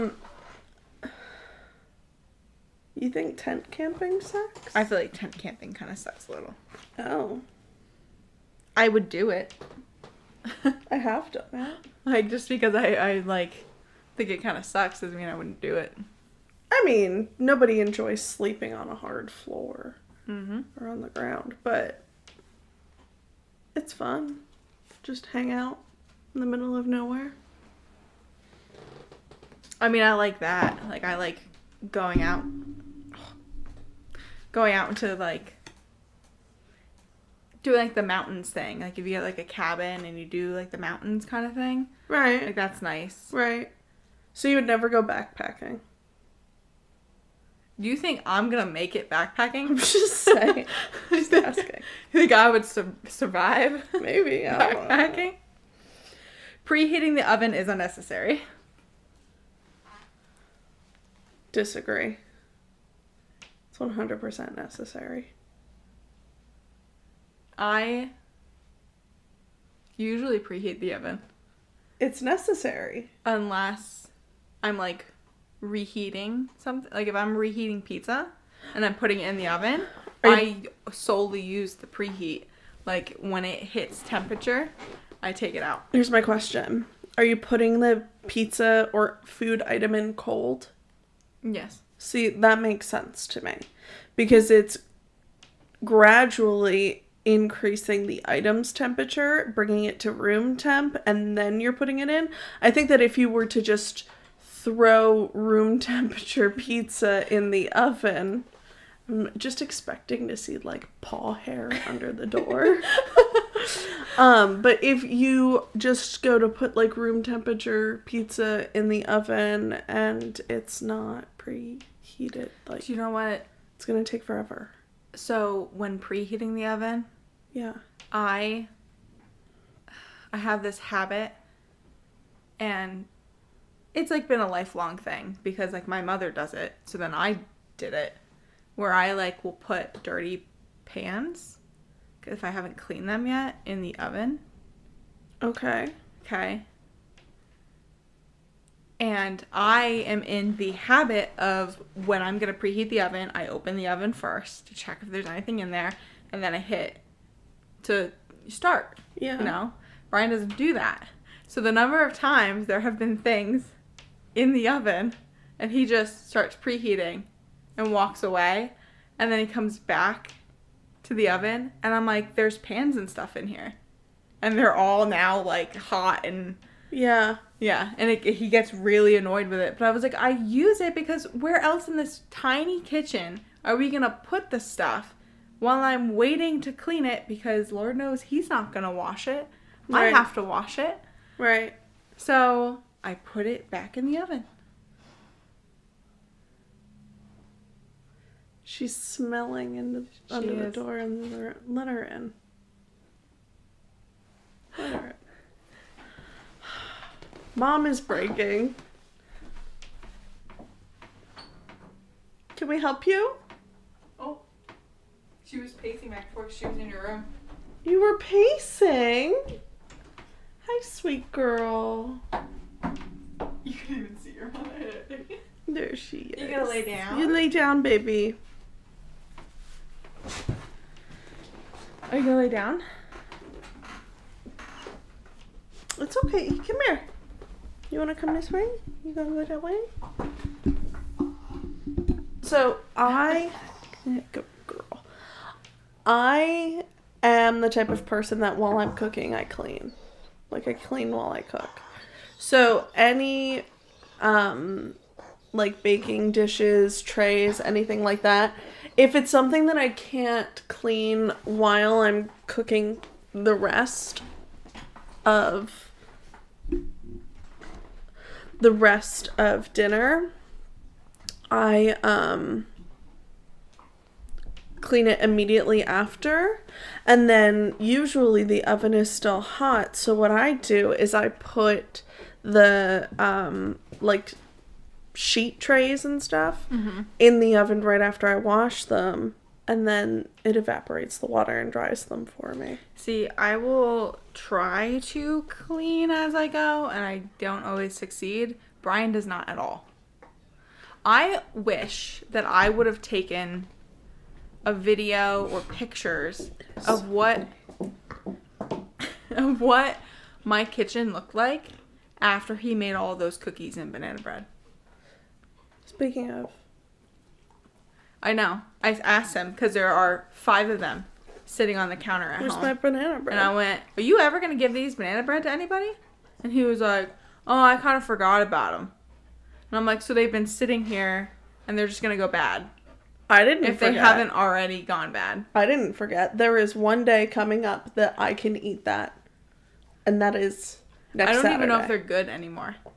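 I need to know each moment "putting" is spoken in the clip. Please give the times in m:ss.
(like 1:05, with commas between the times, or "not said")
1:18, 1:27, 1:41.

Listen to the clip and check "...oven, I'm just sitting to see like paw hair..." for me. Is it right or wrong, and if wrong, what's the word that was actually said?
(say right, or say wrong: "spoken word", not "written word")
wrong: "expecting", not "sitting".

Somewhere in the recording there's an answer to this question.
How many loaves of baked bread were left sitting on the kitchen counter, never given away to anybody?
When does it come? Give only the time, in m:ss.
5:20.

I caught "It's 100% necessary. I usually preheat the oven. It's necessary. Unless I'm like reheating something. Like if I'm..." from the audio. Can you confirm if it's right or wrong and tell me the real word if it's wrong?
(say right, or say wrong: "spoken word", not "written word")
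right.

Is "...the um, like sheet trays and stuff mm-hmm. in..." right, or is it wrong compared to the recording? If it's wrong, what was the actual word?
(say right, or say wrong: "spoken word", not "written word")
right.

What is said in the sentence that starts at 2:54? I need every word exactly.
And they're all now like hot and yeah.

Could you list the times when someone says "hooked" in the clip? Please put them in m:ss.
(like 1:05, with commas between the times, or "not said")
not said.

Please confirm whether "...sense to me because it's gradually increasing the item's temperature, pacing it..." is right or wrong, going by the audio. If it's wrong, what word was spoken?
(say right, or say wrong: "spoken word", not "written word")
wrong: "bringing", not "pacing".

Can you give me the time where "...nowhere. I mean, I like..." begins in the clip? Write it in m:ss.
0:26.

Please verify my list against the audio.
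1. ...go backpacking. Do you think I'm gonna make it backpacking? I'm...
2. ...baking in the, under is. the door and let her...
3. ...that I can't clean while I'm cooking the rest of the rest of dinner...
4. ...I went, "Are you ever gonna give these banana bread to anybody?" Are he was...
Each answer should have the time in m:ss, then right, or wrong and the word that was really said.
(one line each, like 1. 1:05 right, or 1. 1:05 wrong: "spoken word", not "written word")
1. 0:44 right
2. 3:18 wrong: "smelling", not "baking"
3. 4:19 right
4. 5:23 wrong: "And", not "Are".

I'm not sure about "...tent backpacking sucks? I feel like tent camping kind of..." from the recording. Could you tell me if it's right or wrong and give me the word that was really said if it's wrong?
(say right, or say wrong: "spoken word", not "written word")
wrong: "camping", not "backpacking".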